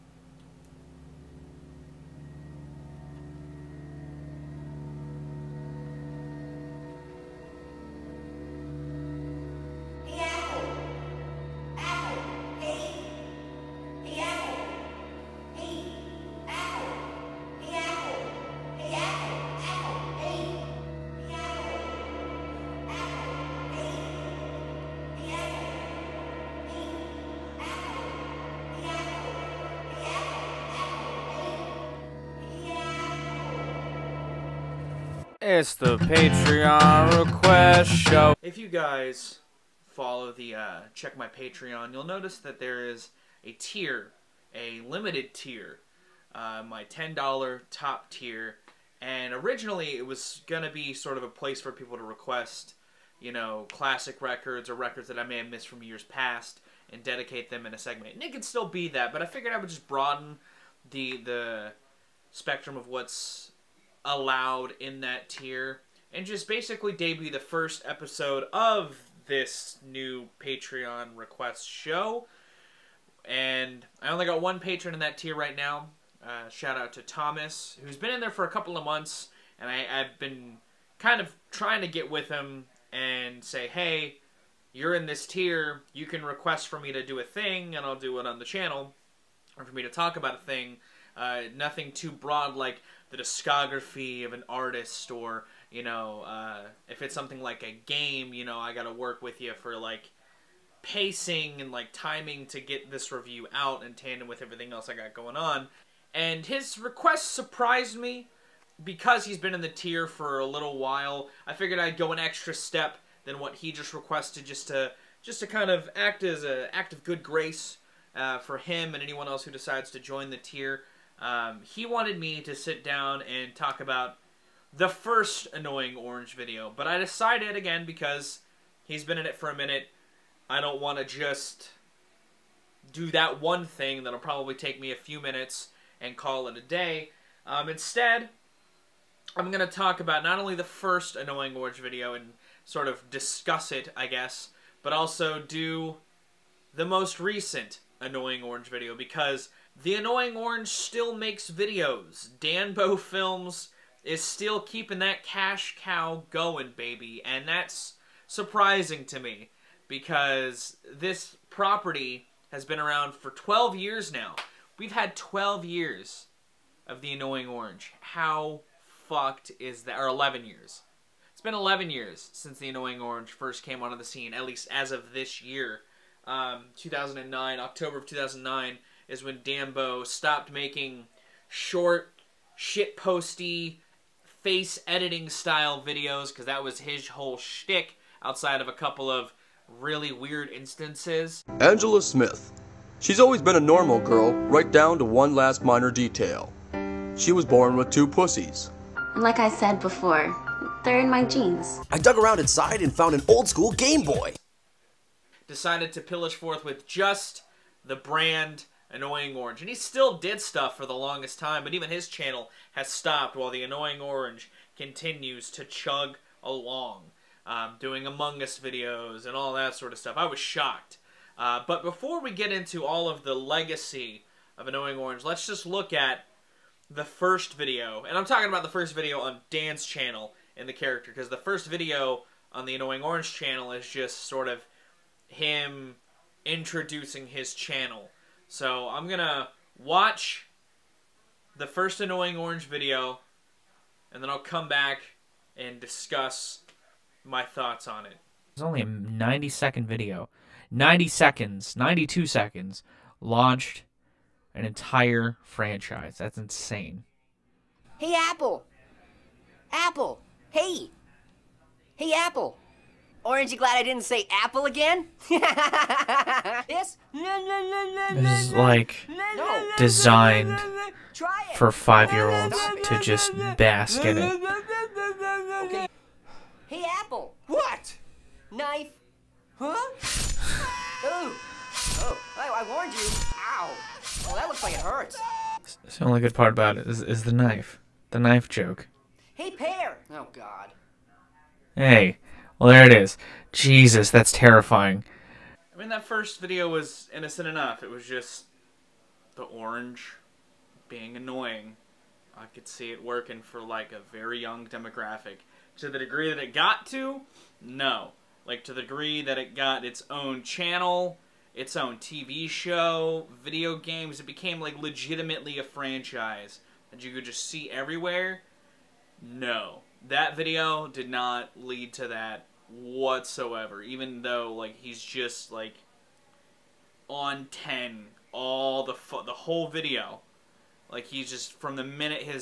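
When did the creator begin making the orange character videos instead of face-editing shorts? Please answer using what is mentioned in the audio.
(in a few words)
October 2009.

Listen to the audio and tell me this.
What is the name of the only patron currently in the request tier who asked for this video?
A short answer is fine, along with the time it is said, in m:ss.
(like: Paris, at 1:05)
Thomas, at 1:17.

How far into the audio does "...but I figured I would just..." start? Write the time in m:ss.
0:59.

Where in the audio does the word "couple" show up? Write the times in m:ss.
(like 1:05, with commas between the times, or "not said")
1:18, 3:08.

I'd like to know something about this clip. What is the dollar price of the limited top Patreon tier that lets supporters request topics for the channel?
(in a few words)
$10.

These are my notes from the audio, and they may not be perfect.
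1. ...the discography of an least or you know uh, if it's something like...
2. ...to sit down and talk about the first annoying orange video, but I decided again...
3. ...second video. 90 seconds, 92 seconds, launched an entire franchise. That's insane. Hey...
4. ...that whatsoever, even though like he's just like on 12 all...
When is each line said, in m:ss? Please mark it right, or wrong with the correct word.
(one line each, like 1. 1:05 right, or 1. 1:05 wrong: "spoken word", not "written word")
1. 1:33 wrong: "artist", not "least"
2. 2:02 right
3. 4:09 right
4. 5:22 wrong: "10", not "12".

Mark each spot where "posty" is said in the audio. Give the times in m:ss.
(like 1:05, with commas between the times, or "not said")
3:02.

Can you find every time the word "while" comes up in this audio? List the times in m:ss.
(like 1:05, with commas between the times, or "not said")
1:50, 3:33.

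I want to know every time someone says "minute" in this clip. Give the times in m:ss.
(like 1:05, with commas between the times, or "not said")
2:09, 2:15, 5:31.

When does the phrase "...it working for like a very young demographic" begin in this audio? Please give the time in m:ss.
5:02.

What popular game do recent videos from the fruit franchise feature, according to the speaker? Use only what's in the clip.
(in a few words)
Among Us.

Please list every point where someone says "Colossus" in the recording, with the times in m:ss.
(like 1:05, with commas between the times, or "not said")
not said.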